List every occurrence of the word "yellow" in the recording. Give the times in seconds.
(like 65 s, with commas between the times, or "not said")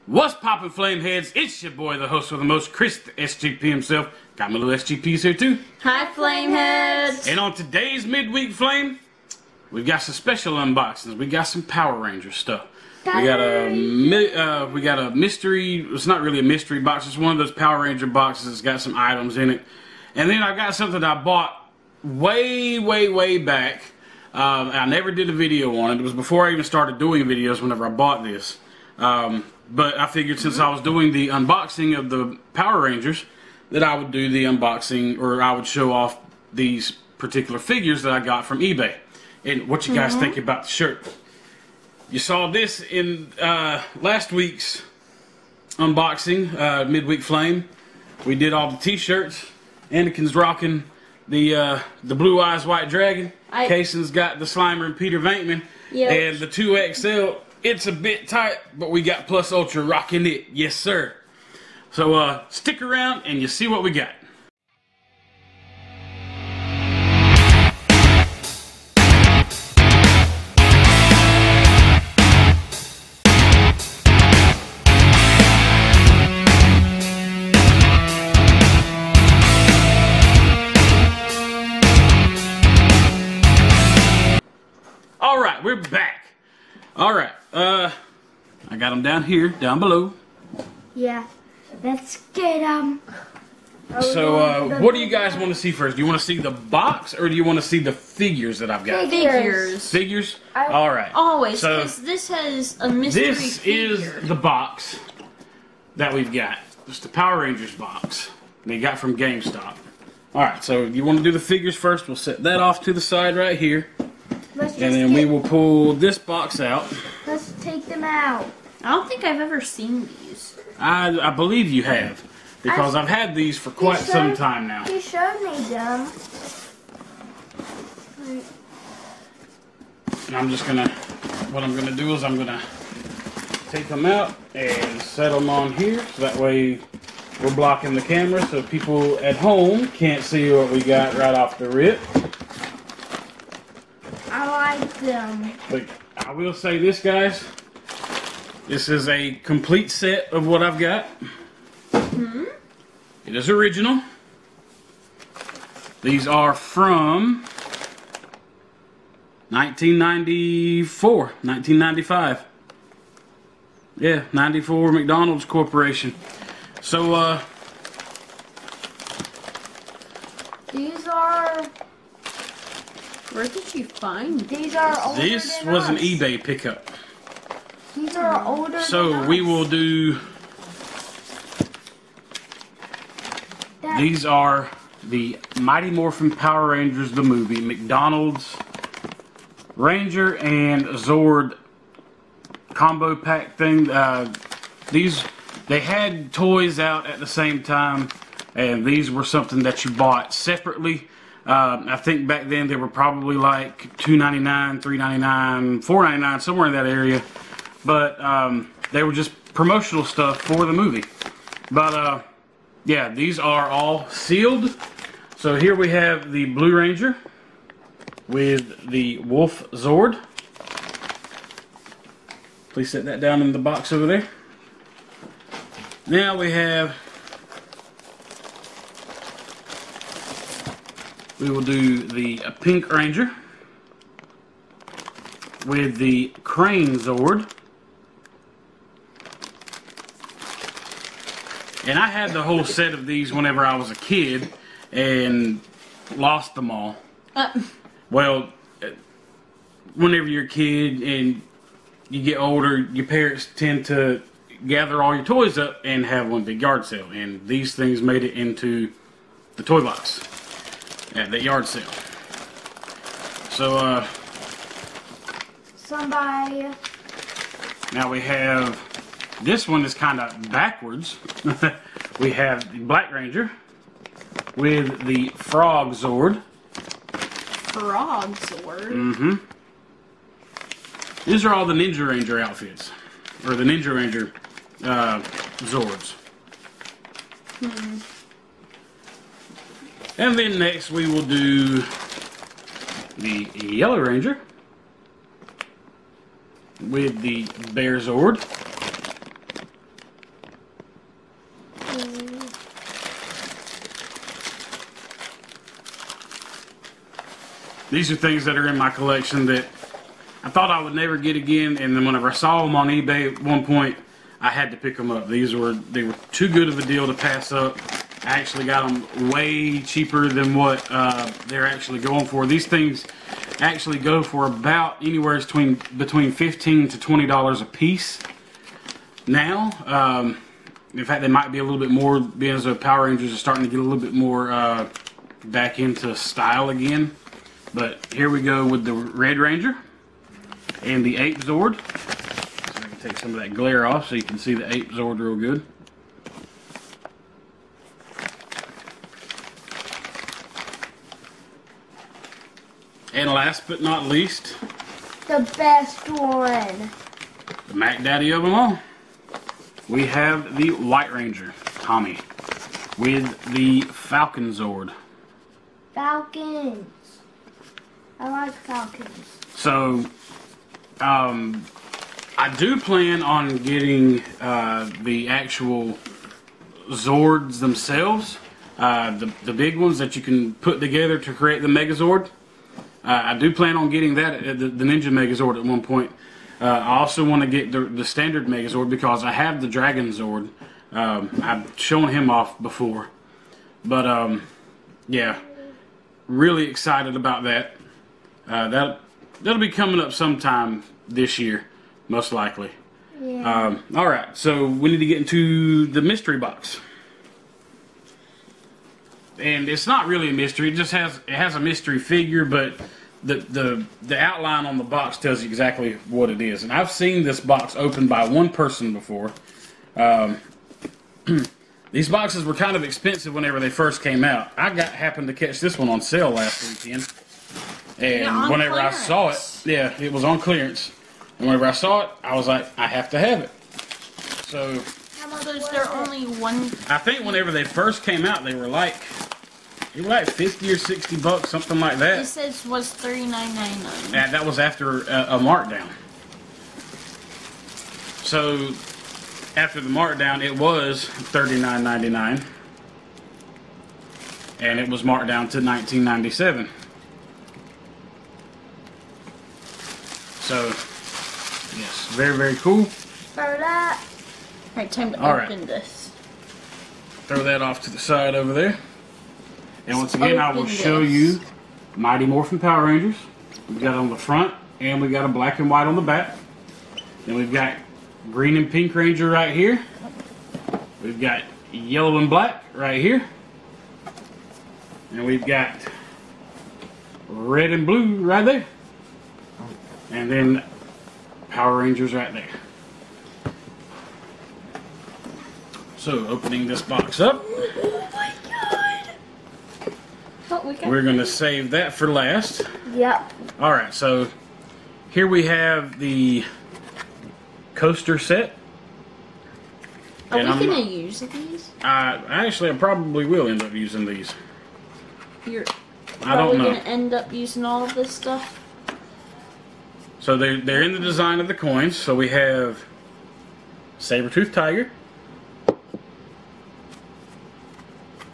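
293 s, 481 s.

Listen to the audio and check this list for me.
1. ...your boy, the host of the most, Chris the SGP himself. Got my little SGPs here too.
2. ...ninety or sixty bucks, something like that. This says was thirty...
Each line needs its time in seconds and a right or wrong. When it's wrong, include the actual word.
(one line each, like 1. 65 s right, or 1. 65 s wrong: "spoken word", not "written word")
1. 1 s right
2. 440 s wrong: "fifty", not "ninety".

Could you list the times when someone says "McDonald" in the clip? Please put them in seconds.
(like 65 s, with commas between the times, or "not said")
164 s, 187 s.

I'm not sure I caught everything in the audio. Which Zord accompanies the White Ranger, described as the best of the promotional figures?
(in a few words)
Falcon Zord.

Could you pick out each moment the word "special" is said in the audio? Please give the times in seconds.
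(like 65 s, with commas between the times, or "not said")
10 s.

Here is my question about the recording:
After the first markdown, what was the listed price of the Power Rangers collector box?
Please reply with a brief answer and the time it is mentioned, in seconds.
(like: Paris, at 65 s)
$39.99, at 451 s.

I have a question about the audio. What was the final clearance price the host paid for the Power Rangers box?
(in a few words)
$19.97.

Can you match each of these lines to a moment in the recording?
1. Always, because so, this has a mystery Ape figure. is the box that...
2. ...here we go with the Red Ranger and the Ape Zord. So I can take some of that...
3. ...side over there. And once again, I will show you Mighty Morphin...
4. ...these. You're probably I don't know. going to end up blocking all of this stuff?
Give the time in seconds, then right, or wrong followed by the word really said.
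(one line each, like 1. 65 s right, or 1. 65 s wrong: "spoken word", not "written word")
1. 101 s wrong: "This", not "Ape"
2. 338 s right
3. 467 s right
4. 514 s wrong: "using", not "blocking".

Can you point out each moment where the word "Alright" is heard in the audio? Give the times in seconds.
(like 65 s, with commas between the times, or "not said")
463 s, 503 s.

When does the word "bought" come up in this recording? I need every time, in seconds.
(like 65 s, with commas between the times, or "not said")
21 s, 27 s, 199 s.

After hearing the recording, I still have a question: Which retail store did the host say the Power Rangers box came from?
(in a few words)
GameStop.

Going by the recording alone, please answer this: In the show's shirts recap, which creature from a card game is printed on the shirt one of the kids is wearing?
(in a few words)
Blue Eyes White Dragon.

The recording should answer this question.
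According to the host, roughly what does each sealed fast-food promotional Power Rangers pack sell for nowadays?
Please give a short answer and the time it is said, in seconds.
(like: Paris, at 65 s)
15 to 20 dollars, at 326 s.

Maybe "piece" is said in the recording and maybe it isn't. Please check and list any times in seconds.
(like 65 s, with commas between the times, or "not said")
327 s.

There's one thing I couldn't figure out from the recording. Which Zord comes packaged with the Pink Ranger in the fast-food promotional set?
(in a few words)
Crane Zord.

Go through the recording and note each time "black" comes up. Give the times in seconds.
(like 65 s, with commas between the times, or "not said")
272 s, 475 s, 482 s.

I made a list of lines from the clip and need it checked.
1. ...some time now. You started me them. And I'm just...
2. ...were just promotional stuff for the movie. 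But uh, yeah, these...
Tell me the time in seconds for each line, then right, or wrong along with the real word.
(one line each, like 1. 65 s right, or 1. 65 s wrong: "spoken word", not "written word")
1. 124 s wrong: "showed", not "started"
2. 209 s right.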